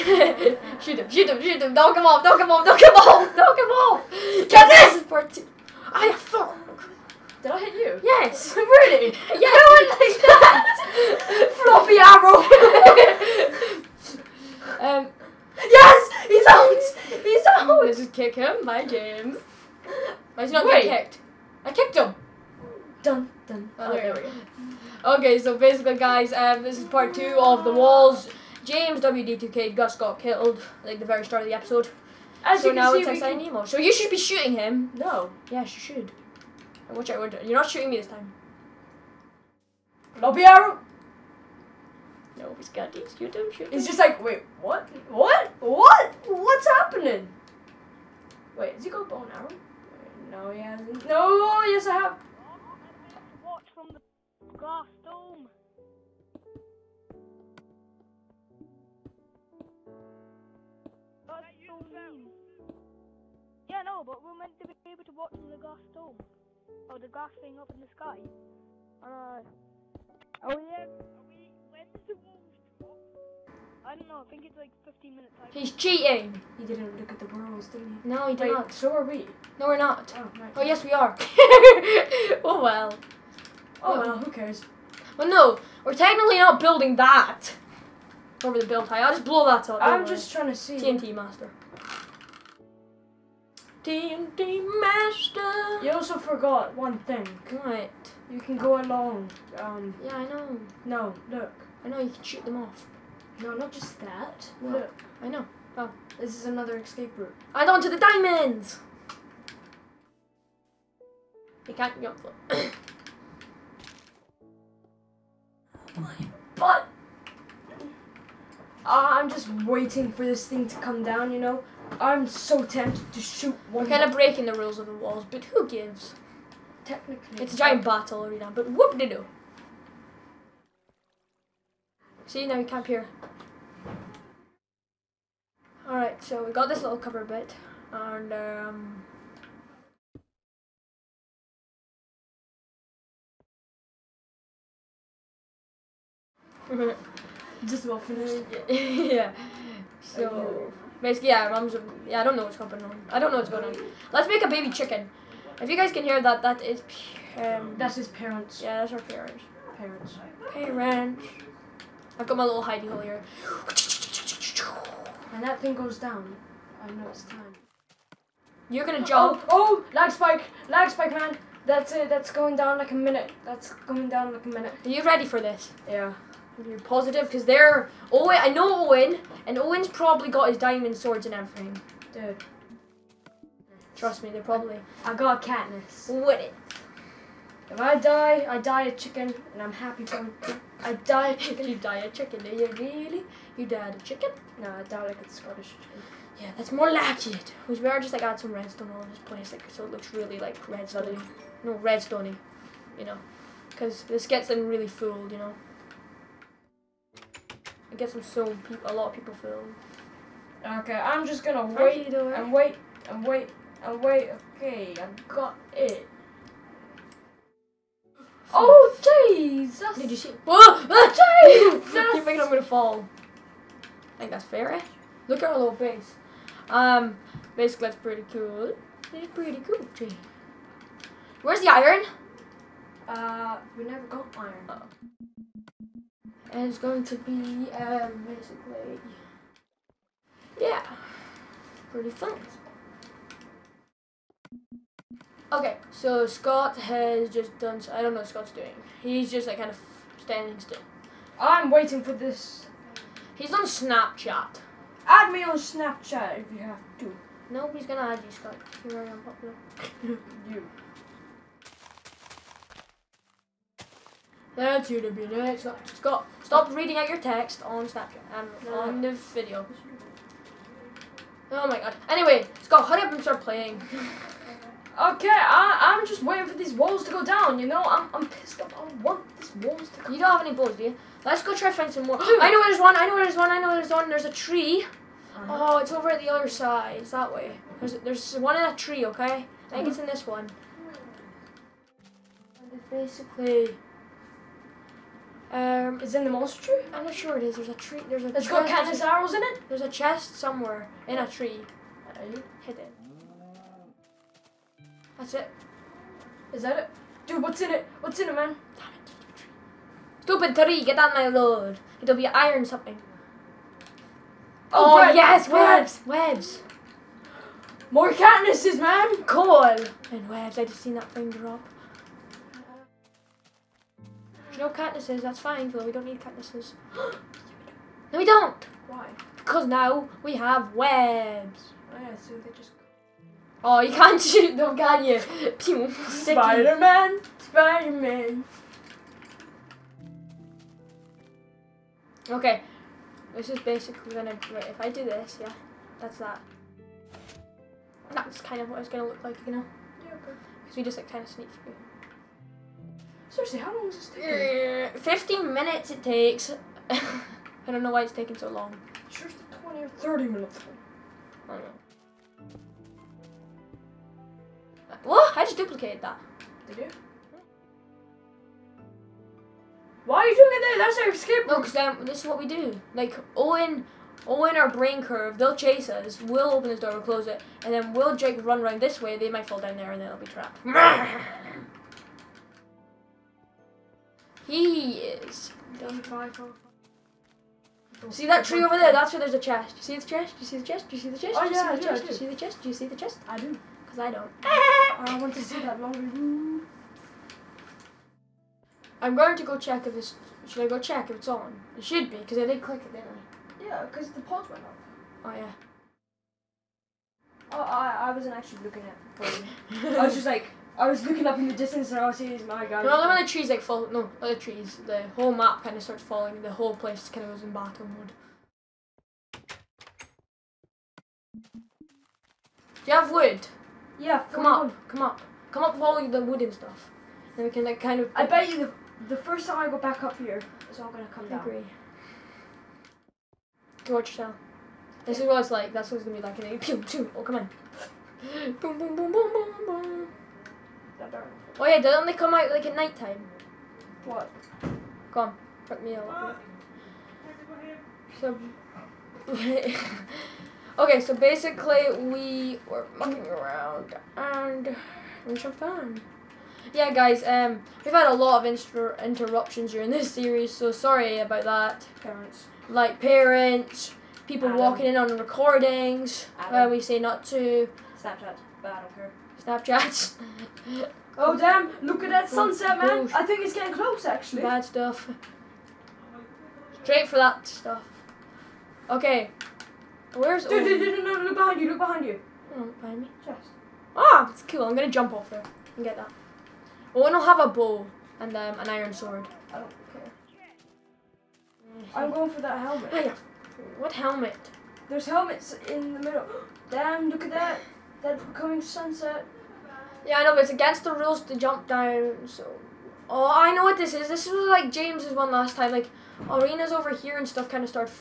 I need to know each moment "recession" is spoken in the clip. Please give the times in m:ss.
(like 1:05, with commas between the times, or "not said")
not said.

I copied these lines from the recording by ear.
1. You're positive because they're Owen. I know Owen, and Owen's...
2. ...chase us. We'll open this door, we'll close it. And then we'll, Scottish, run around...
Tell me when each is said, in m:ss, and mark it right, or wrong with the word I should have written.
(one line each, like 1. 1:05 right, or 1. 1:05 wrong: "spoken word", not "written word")
1. 2:56 right
2. 6:15 wrong: "Jake", not "Scottish".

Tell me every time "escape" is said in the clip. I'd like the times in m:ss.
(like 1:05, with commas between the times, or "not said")
1:46, 6:11.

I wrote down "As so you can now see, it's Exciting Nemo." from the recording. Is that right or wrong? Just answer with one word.
right.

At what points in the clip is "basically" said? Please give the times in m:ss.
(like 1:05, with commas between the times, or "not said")
0:25, 2:31, 3:47, 3:58, 4:52, 5:43, 7:31.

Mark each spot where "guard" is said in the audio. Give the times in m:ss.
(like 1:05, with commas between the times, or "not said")
not said.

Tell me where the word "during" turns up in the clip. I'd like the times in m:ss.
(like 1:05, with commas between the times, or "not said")
7:39.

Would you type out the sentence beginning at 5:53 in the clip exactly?
Seriously, how long is this taking?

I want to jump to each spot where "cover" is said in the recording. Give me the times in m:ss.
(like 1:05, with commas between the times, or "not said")
2:16.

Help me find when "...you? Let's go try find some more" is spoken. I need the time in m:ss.
4:40.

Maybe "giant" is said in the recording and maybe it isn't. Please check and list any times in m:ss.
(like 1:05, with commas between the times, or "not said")
2:07.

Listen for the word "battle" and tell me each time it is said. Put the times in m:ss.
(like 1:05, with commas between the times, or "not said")
2:07, 6:57.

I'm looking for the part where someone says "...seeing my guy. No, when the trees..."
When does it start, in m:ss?
6:52.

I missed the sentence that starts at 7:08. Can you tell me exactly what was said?
I bet you the the first time I go back up here, it's all gonna come I down.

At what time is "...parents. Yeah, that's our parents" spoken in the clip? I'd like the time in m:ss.
2:38.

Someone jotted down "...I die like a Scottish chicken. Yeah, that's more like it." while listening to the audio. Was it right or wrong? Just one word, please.
right.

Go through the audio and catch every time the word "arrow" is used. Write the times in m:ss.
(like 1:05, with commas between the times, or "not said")
0:13, 0:40, 0:49, 4:59.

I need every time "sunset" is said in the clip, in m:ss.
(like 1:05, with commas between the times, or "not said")
7:52, 8:18.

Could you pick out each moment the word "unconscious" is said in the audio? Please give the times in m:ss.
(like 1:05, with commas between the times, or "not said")
not said.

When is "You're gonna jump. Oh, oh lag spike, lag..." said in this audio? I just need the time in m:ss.
2:48.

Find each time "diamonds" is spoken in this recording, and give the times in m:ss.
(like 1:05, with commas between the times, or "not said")
1:47, 3:00.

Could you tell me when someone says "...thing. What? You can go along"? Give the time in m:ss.
1:36.